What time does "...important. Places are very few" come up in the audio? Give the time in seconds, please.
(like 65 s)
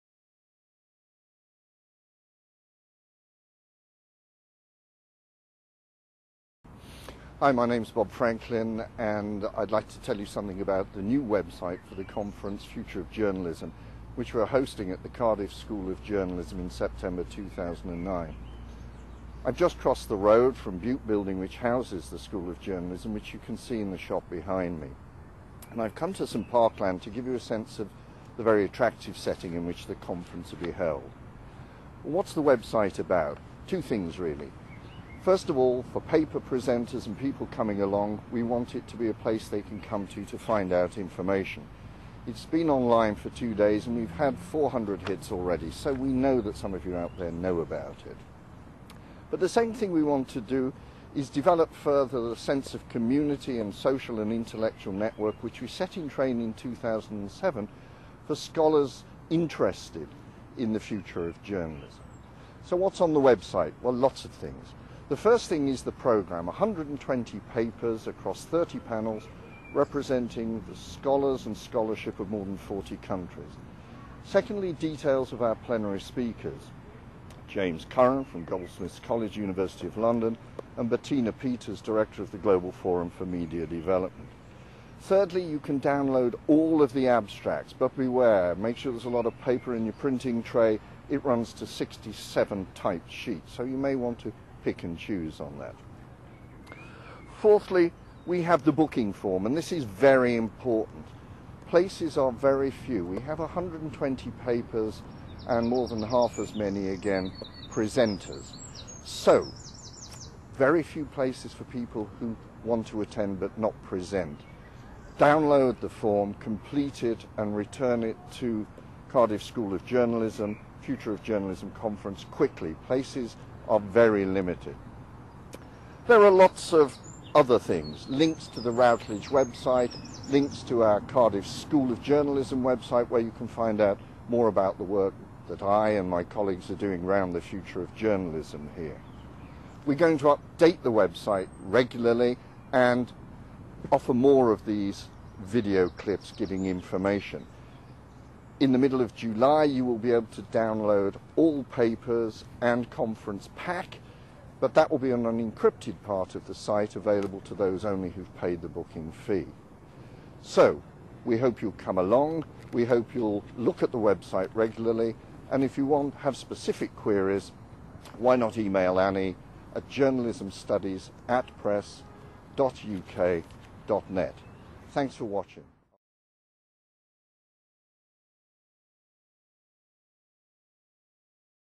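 100 s.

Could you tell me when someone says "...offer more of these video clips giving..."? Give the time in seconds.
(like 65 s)
143 s.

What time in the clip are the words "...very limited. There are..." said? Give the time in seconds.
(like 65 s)
123 s.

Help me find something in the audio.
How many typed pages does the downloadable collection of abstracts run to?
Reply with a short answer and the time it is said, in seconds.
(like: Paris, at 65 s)
67, at 91 s.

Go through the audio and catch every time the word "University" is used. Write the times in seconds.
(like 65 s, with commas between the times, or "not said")
79 s.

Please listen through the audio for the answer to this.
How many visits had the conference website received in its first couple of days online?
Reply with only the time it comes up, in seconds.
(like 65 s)
44 s.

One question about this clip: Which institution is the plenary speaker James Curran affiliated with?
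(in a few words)
Goldsmiths College.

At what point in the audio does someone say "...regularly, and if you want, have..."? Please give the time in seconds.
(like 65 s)
164 s.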